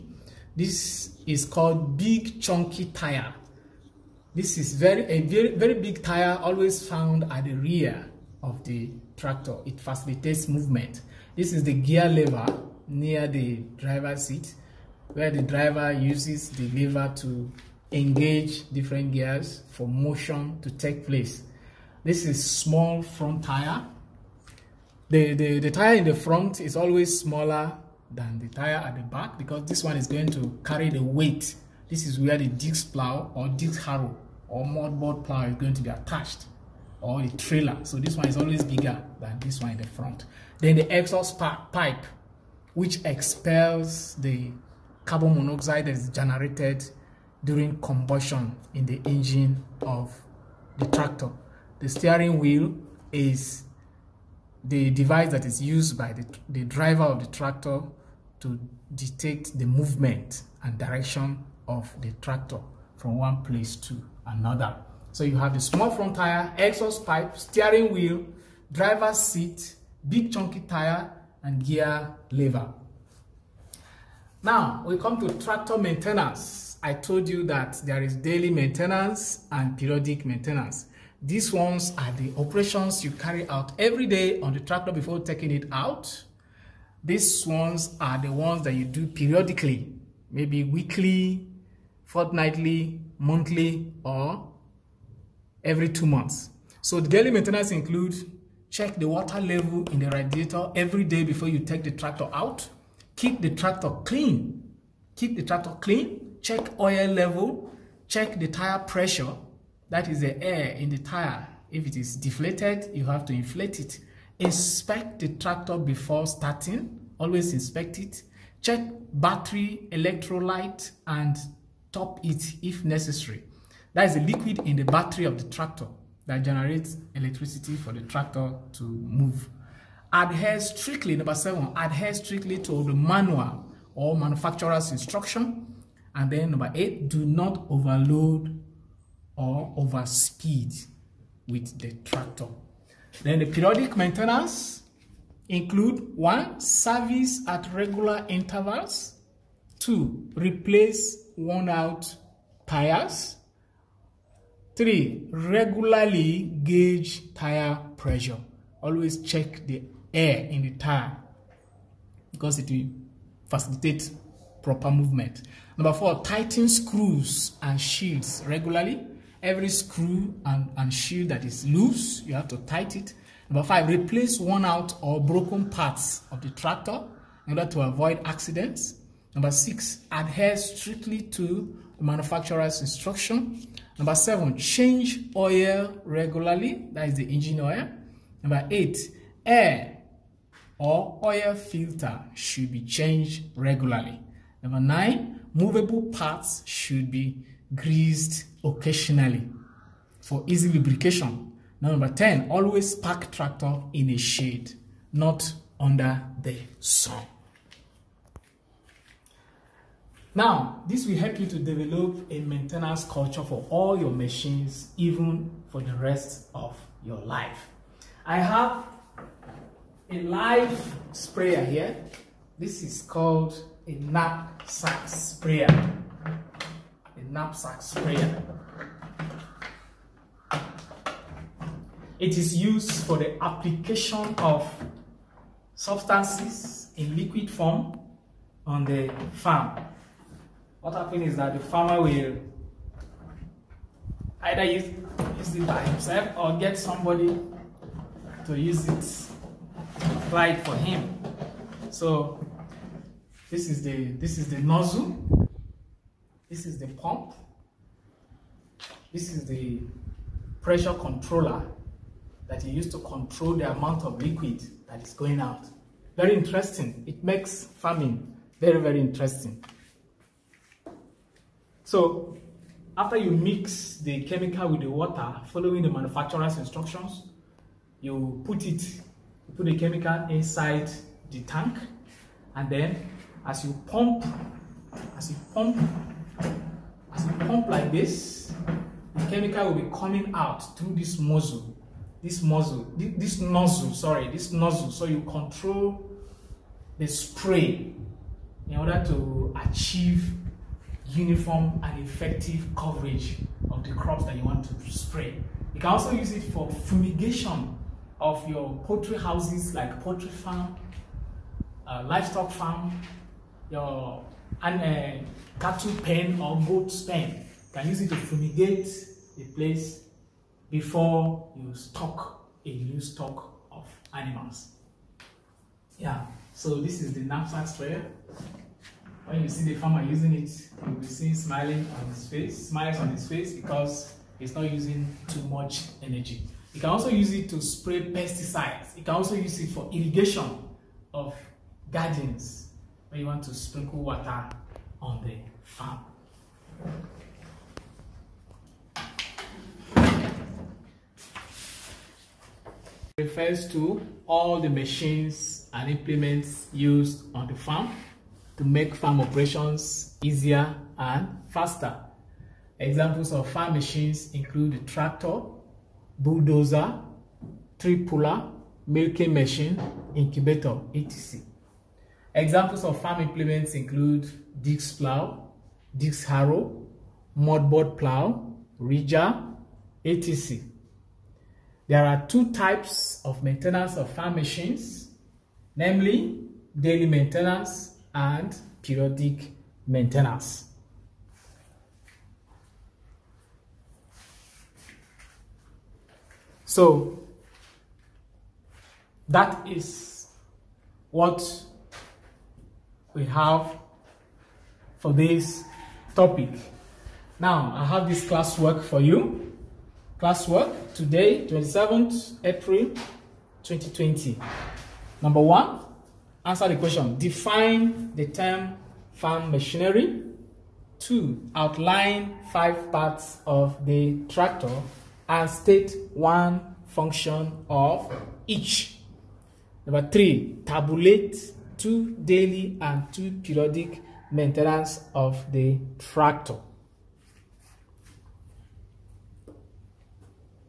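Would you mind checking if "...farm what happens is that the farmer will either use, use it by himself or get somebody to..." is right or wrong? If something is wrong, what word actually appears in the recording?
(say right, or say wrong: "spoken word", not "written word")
right.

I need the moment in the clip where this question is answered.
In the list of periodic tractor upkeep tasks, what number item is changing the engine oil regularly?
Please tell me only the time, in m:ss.
3:03.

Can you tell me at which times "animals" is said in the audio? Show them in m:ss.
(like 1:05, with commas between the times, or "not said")
5:24.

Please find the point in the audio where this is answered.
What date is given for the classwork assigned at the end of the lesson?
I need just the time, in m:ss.
6:51.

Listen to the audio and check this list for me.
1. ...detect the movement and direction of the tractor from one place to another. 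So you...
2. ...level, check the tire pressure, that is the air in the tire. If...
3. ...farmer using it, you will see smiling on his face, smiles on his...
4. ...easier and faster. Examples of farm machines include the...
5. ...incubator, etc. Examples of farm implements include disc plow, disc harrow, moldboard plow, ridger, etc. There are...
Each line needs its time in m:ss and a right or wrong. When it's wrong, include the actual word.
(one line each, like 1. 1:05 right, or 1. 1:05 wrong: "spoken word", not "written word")
1. 0:58 right
2. 1:47 right
3. 5:29 right
4. 6:00 right
5. 6:10 right.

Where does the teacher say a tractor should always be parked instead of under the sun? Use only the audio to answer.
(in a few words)
In a shade.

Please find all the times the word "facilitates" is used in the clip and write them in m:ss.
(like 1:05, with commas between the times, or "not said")
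0:09, 2:43.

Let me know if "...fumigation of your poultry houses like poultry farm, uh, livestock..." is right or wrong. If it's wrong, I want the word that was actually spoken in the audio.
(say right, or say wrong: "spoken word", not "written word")
right.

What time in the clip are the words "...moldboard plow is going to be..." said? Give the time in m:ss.
0:34.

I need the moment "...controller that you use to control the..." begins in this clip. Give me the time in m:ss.
4:20.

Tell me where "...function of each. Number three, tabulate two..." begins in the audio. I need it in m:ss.
7:06.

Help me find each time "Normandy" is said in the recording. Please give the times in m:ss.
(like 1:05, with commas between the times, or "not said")
not said.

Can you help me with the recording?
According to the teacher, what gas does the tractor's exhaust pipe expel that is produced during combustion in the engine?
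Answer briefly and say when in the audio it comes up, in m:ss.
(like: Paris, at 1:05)
Carbon monoxide, at 0:45.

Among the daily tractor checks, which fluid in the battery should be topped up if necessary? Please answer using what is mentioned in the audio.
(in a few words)
Electrolyte.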